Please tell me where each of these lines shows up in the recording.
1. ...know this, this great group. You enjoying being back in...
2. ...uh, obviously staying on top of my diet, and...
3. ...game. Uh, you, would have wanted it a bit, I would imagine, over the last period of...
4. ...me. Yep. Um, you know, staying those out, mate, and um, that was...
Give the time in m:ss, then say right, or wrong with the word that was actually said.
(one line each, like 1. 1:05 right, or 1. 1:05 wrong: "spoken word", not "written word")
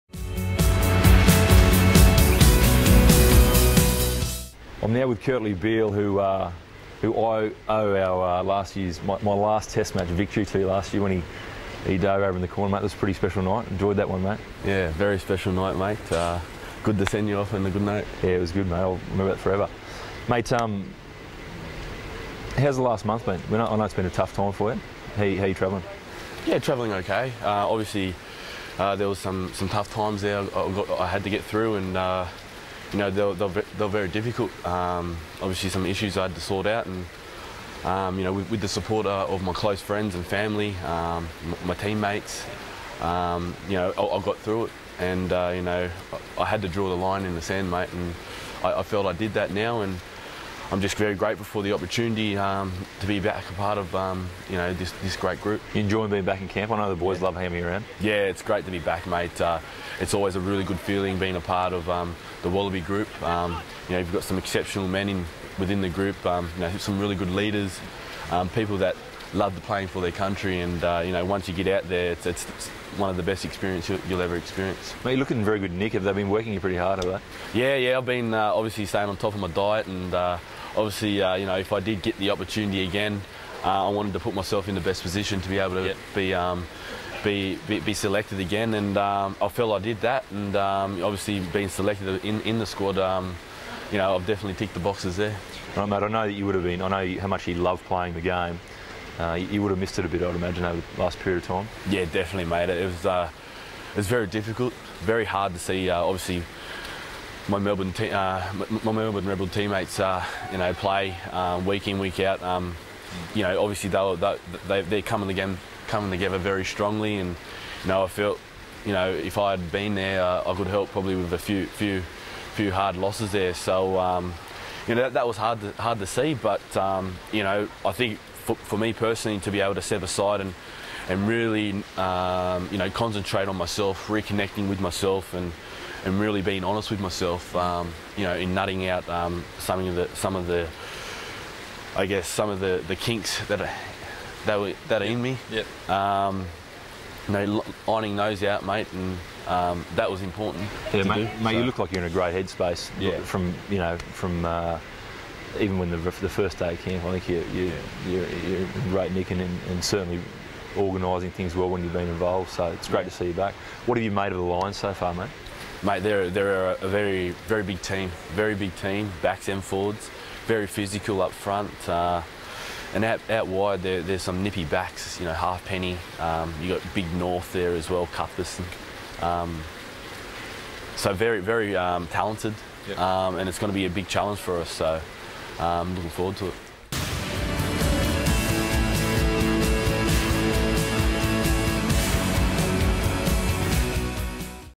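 1. 0:54 right
2. 1:18 right
3. 1:38 wrong: "missed", not "wanted"
4. 2:25 wrong: "ironing", not "staying".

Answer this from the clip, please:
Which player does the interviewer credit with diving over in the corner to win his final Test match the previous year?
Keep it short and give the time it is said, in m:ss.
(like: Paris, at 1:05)
Kurtley Beale, at 0:05.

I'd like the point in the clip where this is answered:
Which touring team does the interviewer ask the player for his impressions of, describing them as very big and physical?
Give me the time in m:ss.
2:44.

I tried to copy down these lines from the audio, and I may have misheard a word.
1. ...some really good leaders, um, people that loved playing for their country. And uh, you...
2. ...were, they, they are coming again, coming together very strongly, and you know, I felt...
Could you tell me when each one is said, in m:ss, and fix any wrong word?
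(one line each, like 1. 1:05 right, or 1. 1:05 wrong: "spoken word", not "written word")
1. 1:06 right
2. 1:53 right.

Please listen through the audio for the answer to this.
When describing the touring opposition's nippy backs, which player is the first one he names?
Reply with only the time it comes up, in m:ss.
2:55.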